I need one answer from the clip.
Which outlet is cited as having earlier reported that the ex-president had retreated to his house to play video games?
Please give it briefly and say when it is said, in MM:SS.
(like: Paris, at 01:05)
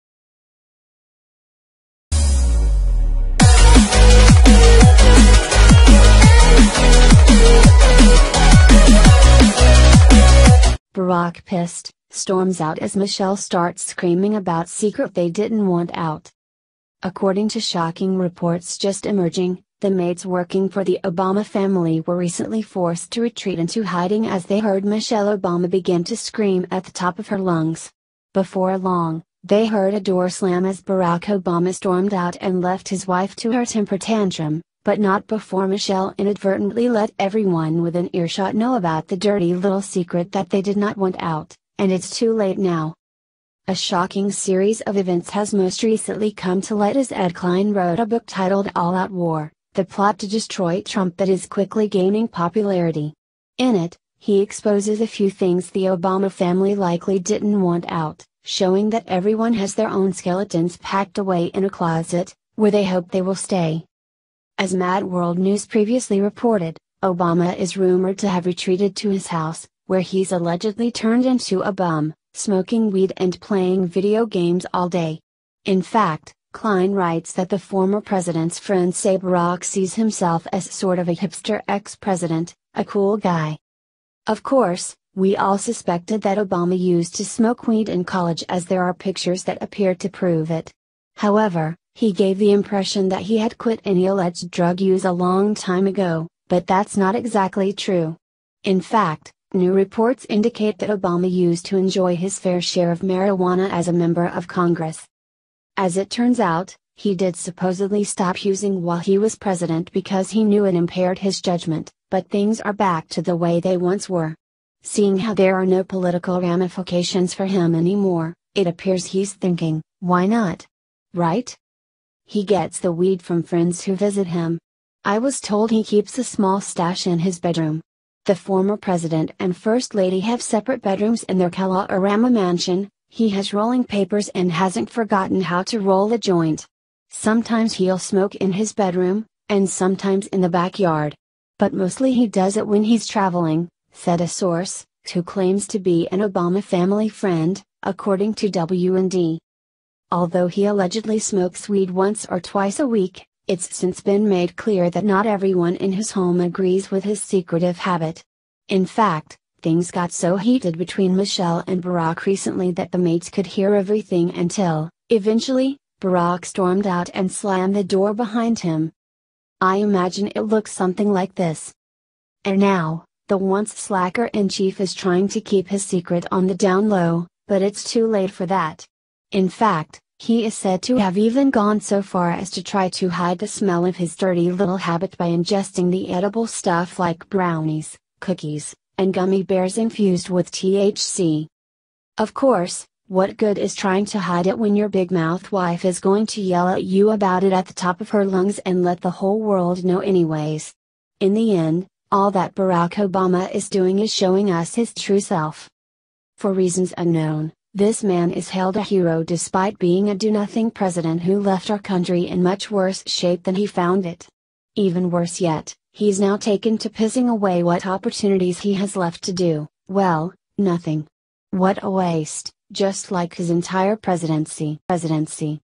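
Mad World News, at 01:04.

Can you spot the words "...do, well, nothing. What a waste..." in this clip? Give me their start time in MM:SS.
03:39.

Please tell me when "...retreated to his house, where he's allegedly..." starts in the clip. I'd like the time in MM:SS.
01:08.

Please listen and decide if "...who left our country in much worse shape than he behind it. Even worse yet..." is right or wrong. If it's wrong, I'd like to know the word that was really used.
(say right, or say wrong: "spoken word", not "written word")
wrong: "found", not "behind".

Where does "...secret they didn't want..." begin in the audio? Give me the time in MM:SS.
00:14.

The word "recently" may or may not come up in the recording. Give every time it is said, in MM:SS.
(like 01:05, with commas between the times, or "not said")
00:22, 00:45, 02:42.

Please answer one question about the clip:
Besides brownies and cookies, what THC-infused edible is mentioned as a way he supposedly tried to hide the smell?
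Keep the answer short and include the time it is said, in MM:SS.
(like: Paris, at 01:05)
gummy bears, at 03:09.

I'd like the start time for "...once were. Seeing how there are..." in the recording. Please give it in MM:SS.
01:53.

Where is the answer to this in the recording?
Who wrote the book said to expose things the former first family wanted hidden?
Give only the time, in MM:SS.
00:47.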